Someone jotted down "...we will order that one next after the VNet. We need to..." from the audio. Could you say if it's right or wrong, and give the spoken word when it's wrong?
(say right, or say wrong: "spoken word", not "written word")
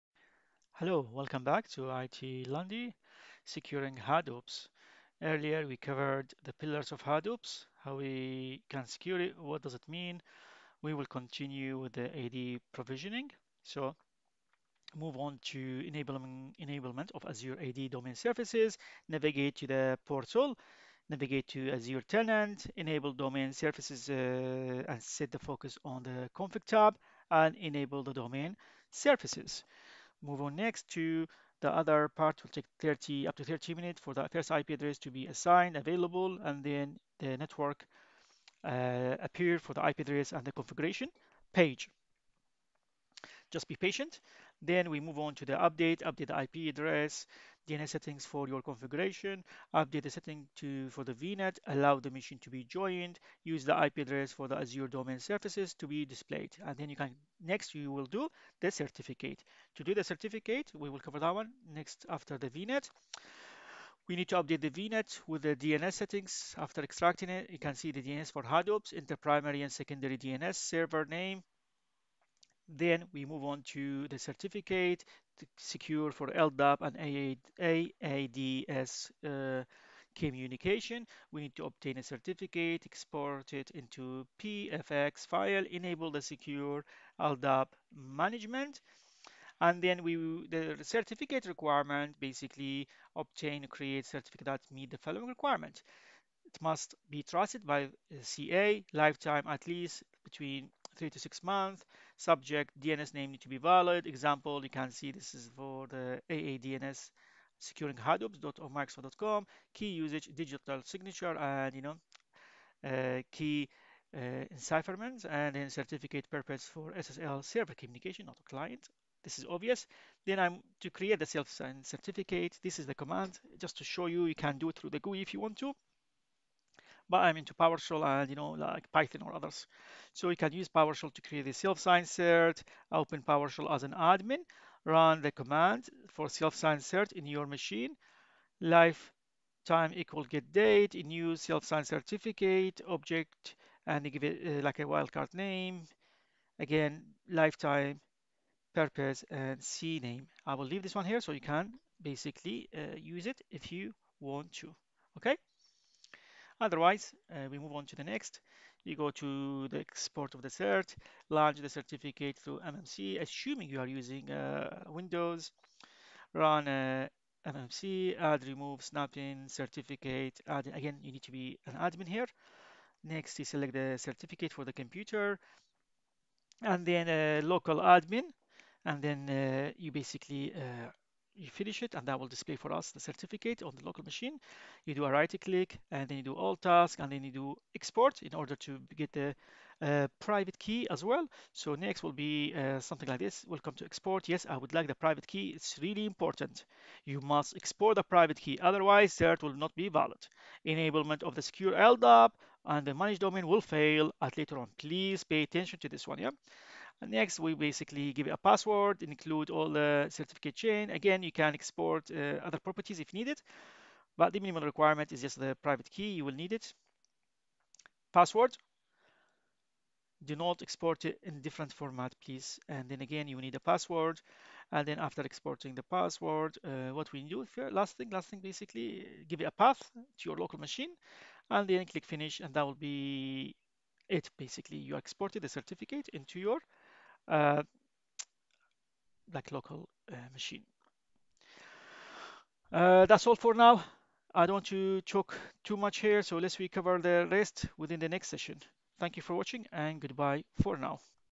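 wrong: "cover", not "order".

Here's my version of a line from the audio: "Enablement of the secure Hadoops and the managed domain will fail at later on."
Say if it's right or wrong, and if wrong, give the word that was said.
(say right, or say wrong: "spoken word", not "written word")
wrong: "LDAP", not "Hadoops".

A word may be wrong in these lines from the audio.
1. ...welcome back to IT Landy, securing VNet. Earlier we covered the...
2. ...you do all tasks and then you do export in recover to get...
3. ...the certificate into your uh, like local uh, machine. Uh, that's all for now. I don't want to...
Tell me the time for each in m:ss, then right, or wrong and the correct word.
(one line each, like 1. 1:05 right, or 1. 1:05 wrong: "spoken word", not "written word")
1. 0:01 wrong: "Hadoop", not "VNet"
2. 3:06 wrong: "order", not "recover"
3. 3:55 right.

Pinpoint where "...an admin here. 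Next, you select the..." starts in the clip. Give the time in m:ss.
2:51.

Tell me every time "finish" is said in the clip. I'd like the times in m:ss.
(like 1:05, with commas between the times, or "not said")
3:01, 3:52.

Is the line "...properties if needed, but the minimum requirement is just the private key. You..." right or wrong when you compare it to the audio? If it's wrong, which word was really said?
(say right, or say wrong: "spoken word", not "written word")
right.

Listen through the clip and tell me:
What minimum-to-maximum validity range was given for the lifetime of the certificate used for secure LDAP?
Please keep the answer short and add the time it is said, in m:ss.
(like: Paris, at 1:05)
3 to 6 months, at 1:40.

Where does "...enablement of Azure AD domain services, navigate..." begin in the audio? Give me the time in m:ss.
0:16.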